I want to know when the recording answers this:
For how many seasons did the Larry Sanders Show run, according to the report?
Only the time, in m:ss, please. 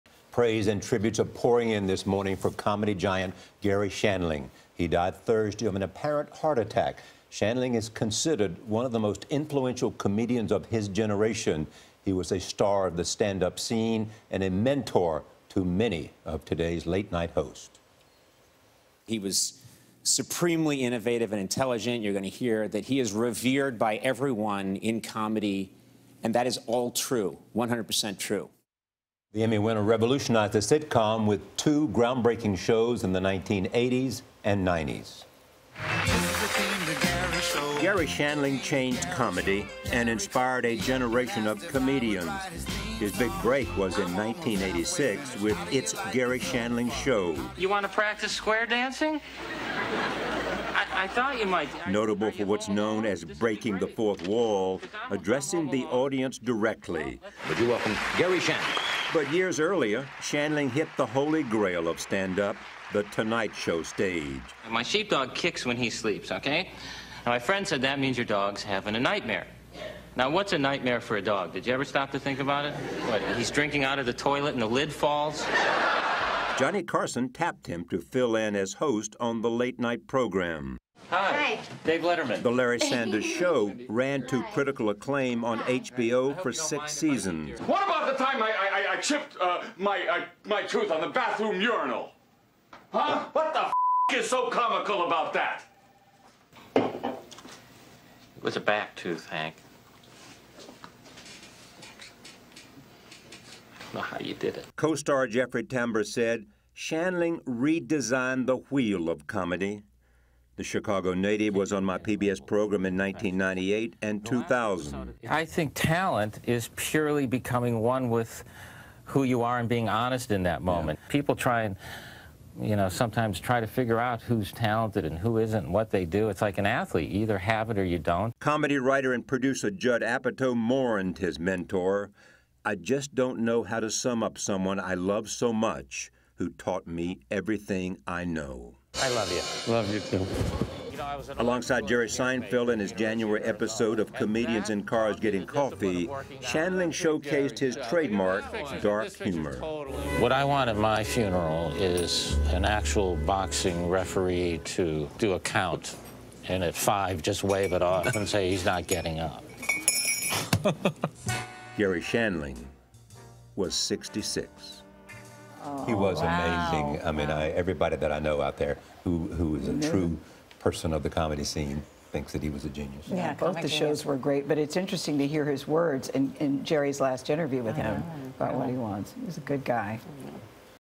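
1:26.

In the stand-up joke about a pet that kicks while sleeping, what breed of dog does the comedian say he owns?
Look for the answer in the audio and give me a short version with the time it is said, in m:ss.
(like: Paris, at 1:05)
sheepdog, at 1:04.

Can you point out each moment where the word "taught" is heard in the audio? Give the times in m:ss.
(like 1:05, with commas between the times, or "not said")
2:16.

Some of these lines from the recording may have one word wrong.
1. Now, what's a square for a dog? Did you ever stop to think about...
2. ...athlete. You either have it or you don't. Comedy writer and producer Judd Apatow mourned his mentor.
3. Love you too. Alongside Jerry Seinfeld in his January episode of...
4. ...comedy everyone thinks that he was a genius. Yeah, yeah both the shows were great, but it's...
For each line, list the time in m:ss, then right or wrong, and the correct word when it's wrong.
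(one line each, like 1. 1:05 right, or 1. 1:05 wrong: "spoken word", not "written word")
1. 1:10 wrong: "nightmare", not "square"
2. 2:06 right
3. 2:19 right
4. 2:51 wrong: "scene", not "everyone".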